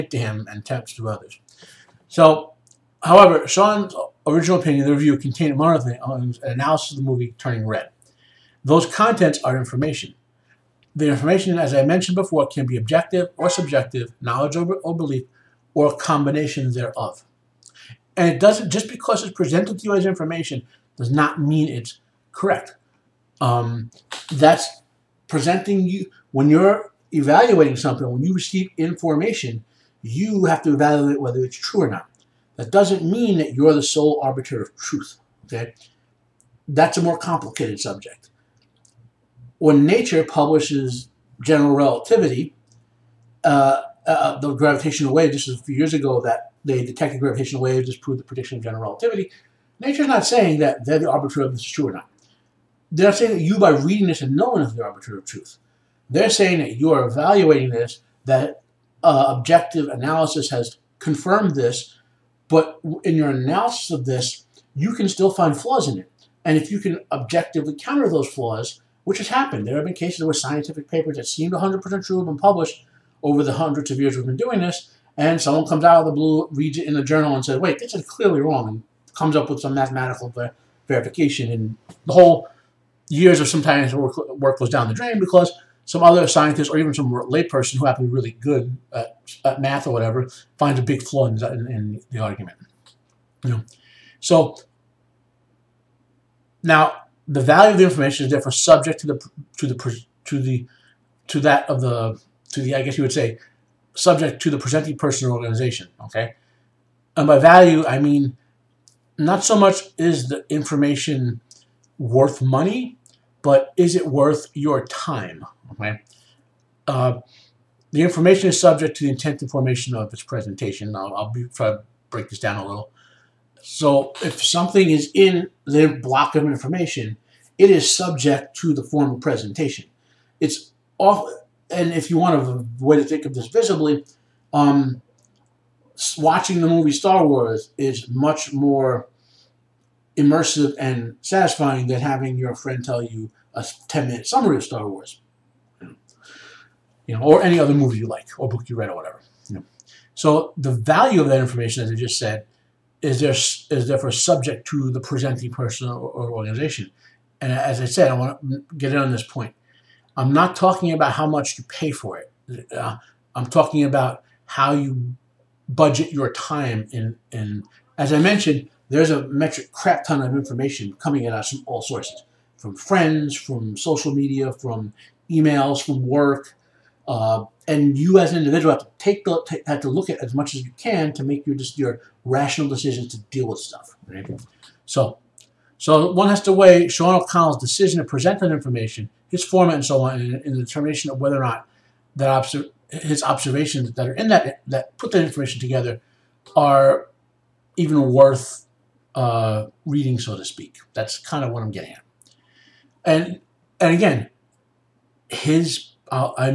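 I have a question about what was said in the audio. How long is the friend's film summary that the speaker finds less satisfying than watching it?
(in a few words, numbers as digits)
10 minutes.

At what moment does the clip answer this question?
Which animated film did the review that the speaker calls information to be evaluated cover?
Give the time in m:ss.
0:07.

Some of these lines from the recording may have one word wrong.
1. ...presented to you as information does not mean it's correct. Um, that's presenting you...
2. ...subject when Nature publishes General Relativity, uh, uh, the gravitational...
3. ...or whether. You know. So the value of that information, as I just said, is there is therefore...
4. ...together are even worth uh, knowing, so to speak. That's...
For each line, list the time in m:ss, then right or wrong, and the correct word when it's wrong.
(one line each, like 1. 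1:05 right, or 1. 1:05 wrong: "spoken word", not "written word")
1. 0:19 right
2. 0:37 right
3. 2:28 wrong: "whatever", not "whether"
4. 3:15 wrong: "reading", not "knowing".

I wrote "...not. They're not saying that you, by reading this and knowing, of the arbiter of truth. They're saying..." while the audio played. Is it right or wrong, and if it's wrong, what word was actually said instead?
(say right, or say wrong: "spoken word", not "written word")
right.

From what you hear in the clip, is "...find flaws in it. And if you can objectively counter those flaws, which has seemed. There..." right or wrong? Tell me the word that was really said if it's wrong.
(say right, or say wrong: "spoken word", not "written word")
wrong: "happened", not "seemed".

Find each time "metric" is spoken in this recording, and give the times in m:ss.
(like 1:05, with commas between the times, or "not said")
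2:49.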